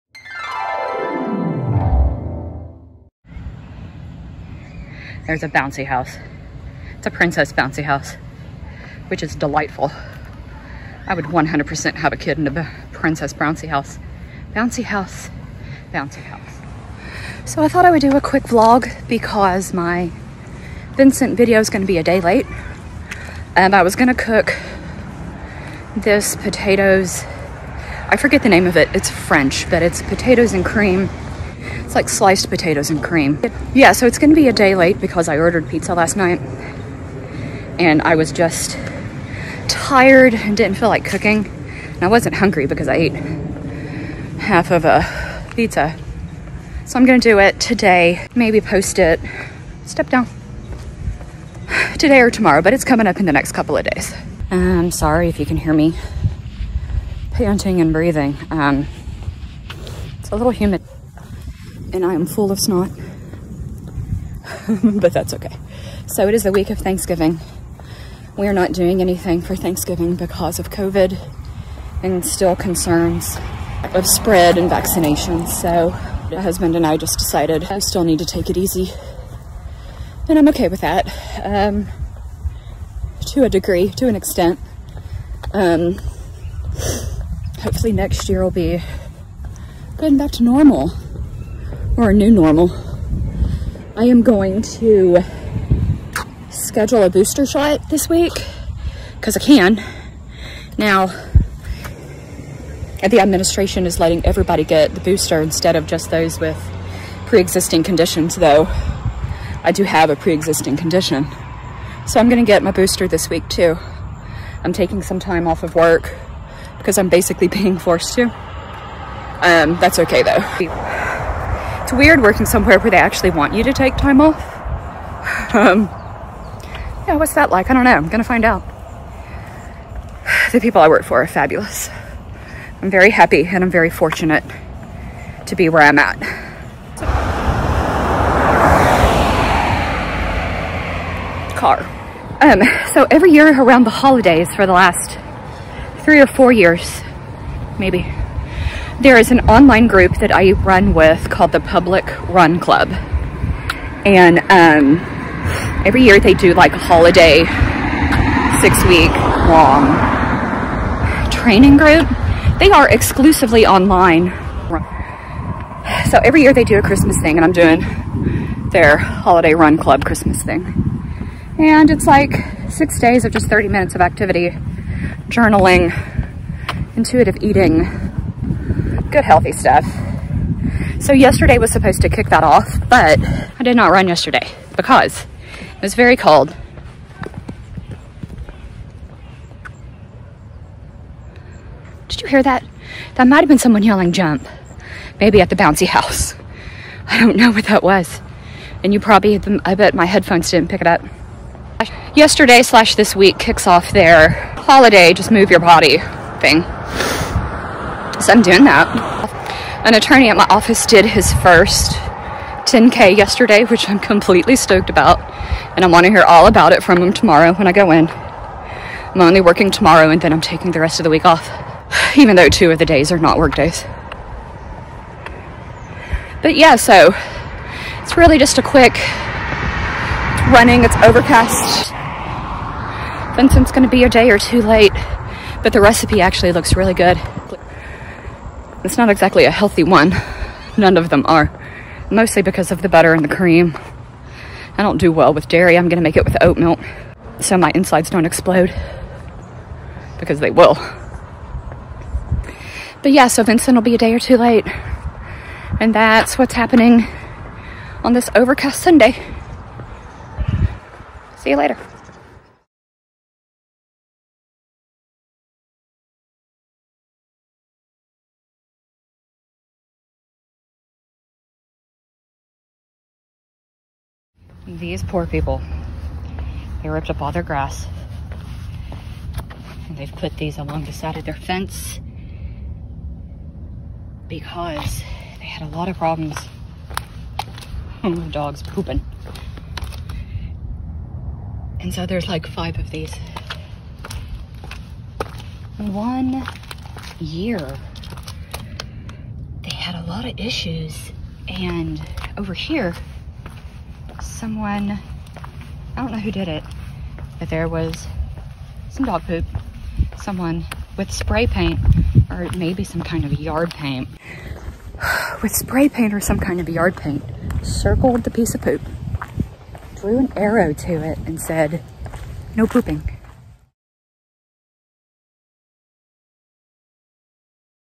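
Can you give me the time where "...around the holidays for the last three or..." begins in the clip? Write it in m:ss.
2:23.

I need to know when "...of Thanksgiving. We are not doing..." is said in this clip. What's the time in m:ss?
1:06.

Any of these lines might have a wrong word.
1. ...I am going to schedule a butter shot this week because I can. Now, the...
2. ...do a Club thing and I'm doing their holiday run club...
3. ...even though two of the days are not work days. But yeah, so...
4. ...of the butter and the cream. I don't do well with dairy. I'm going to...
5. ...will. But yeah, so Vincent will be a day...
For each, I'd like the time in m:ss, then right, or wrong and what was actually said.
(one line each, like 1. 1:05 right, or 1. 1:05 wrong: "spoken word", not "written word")
1. 1:33 wrong: "booster", not "butter"
2. 2:46 wrong: "Christmas", not "Club"
3. 3:42 right
4. 4:02 right
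5. 4:10 right.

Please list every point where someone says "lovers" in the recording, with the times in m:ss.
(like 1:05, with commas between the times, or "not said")
not said.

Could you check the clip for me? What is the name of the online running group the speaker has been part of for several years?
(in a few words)
Public Run Club.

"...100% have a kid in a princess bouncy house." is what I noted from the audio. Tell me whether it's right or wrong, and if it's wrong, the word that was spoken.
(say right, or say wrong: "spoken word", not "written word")
right.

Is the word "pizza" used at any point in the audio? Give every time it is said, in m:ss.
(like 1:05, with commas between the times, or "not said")
0:35, 0:45.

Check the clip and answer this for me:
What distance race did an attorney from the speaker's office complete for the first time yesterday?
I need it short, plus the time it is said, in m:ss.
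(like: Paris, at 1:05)
10K, at 3:32.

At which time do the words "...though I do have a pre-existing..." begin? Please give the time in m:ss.
1:48.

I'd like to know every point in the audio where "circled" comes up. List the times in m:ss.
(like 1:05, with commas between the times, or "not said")
5:17.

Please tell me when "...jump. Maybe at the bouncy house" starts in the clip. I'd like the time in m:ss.
3:14.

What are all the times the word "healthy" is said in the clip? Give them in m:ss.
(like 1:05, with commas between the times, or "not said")
2:59, 3:59.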